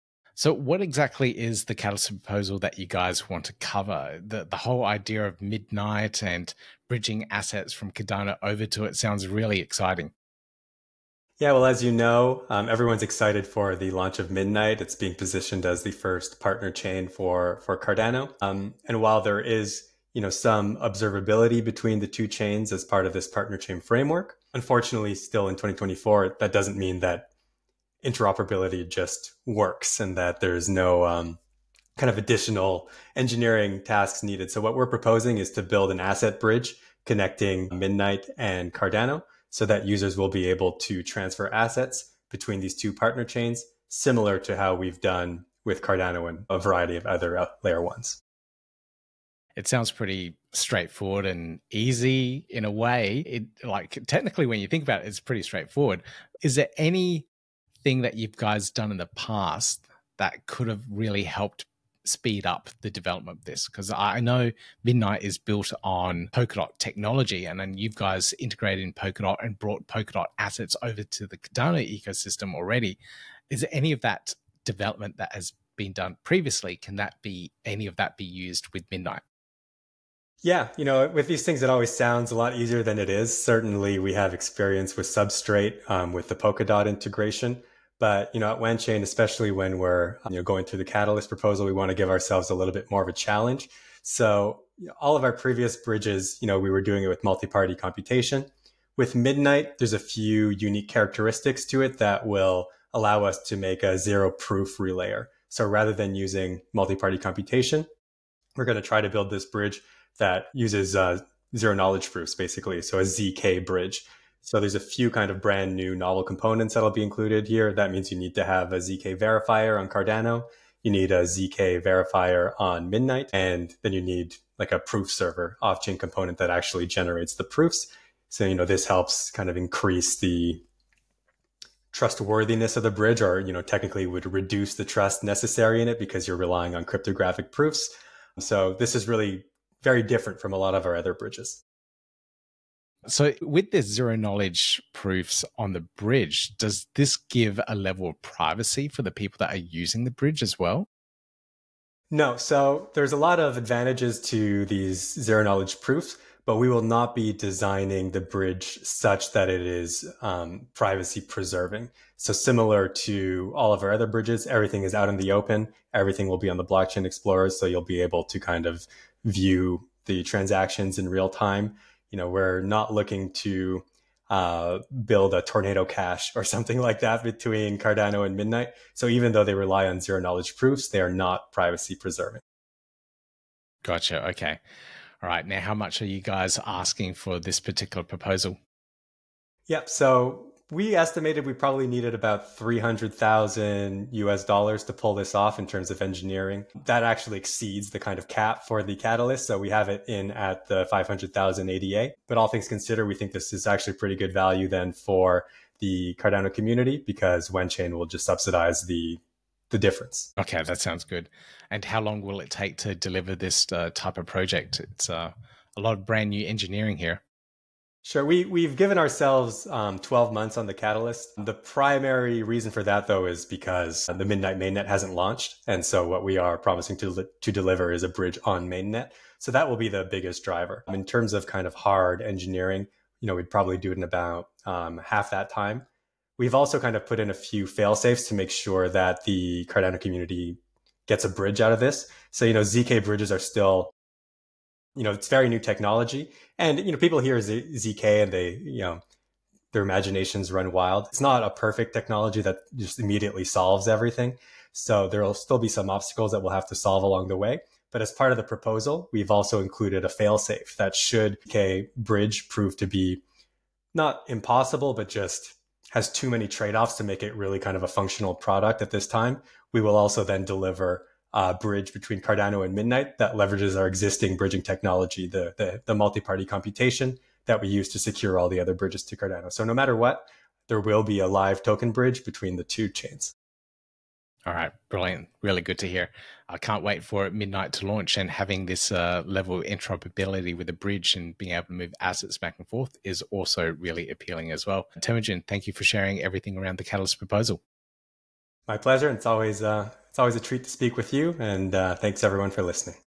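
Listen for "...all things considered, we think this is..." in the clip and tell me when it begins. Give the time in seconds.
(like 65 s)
202 s.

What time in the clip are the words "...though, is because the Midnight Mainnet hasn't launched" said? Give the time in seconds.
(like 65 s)
223 s.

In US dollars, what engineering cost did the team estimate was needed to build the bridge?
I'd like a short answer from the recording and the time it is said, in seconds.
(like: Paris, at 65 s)
$300,000, at 192 s.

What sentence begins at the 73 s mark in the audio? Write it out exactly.
Is any of that development that has been done previously?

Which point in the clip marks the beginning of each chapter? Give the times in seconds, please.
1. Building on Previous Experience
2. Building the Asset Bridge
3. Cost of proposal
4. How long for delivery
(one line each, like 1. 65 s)
1. 49 s
2. 150 s
3. 183 s
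4. 210 s.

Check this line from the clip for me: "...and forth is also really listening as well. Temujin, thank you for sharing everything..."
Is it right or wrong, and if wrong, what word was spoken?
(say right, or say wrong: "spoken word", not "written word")
wrong: "appealing", not "listening".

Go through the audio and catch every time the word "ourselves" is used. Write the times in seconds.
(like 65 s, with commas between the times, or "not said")
92 s, 218 s.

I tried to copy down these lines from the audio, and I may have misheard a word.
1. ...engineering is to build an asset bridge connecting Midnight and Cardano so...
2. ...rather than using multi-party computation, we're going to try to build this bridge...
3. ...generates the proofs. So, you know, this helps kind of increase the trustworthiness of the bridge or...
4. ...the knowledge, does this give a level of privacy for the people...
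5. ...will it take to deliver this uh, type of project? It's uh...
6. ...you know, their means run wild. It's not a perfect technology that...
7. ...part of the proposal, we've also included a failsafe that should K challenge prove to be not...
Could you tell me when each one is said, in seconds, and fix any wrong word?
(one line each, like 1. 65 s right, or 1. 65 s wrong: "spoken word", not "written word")
1. 34 s wrong: "proposing", not "engineering"
2. 105 s right
3. 126 s right
4. 145 s wrong: "bridge", not "knowledge"
5. 212 s right
6. 248 s wrong: "imaginations", not "means"
7. 258 s wrong: "bridge", not "challenge".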